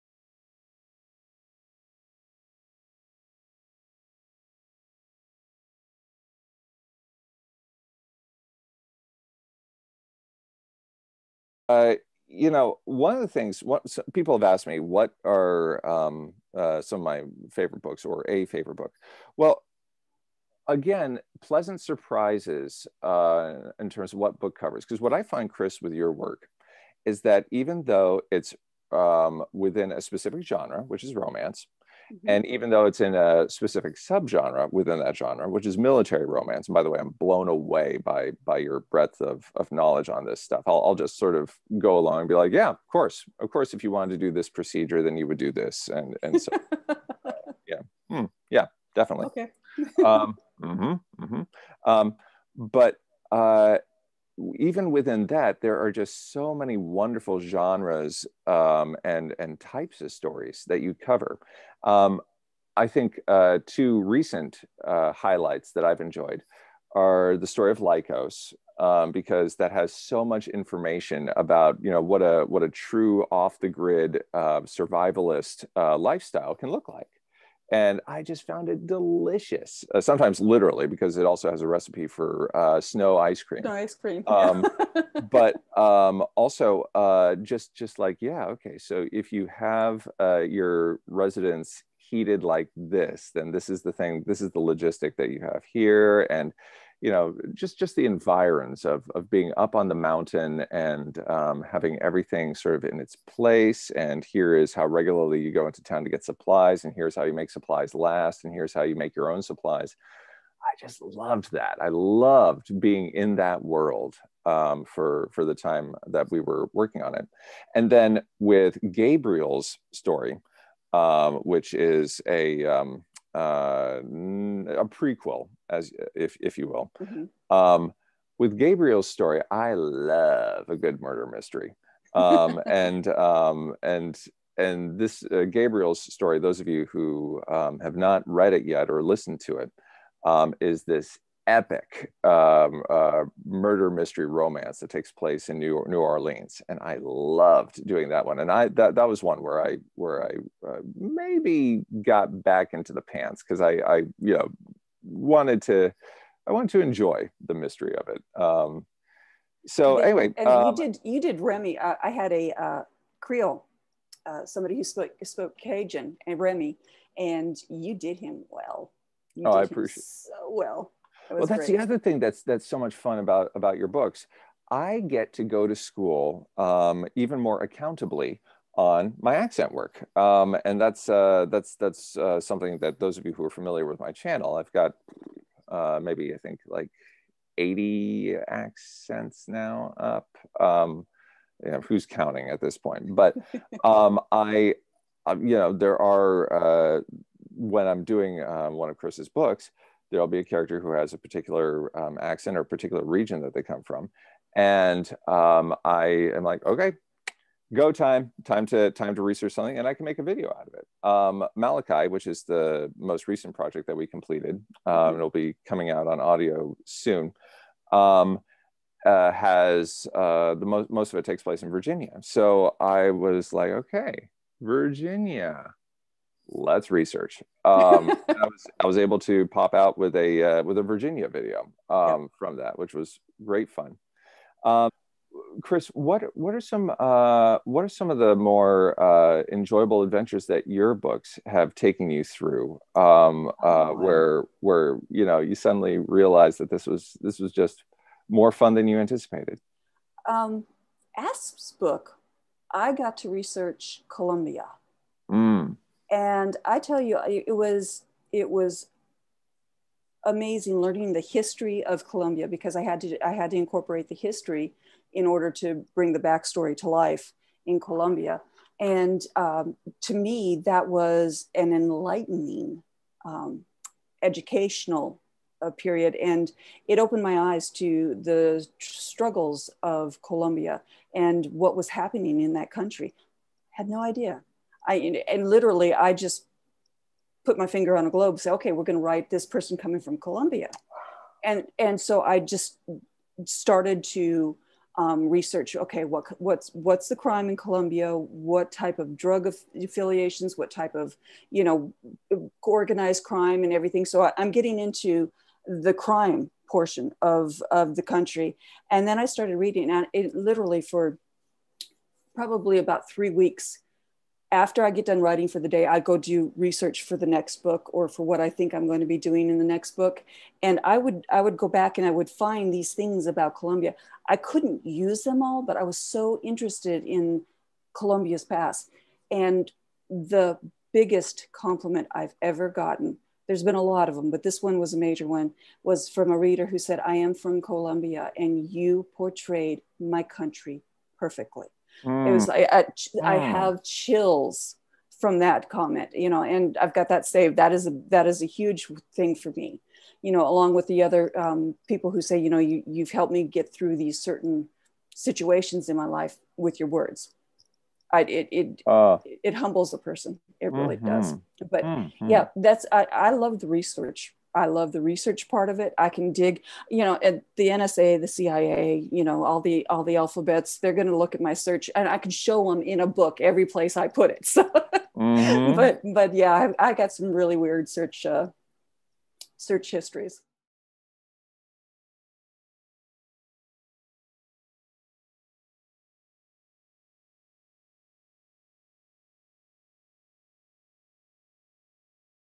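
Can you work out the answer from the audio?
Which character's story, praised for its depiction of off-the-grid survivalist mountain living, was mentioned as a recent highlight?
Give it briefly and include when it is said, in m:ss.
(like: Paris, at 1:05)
Lycos, at 1:07.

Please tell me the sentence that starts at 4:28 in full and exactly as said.
And um, to me, that was an enlightening um, educational uh, period.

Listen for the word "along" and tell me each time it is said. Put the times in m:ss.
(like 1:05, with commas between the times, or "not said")
0:41, 5:50.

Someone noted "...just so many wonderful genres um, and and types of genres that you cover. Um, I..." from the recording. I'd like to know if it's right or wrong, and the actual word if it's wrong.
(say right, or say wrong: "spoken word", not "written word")
wrong: "stories", not "genres".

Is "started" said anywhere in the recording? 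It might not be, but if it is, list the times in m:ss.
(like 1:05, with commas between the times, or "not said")
4:53, 5:09.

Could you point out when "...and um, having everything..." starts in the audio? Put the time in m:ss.
1:40.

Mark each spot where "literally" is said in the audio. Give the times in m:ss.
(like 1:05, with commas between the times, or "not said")
1:20, 4:45, 5:10.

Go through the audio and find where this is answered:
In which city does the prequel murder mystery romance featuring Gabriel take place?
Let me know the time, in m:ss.
2:25.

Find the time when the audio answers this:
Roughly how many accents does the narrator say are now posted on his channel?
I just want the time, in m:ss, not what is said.
3:07.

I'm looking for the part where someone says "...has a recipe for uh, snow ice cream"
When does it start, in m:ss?
1:21.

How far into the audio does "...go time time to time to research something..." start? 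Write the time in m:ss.
3:27.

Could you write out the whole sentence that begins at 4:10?
Um, Asp's book, I got to research Colombia.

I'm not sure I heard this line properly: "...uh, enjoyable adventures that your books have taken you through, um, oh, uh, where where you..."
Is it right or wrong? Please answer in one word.
right.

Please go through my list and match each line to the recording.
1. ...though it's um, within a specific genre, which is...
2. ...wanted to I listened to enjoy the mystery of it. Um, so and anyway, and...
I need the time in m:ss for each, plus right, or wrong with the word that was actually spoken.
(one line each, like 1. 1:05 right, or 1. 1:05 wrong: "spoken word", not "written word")
1. 0:27 right
2. 2:35 wrong: "wanted", not "listened".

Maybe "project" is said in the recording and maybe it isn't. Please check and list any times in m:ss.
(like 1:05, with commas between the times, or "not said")
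3:33.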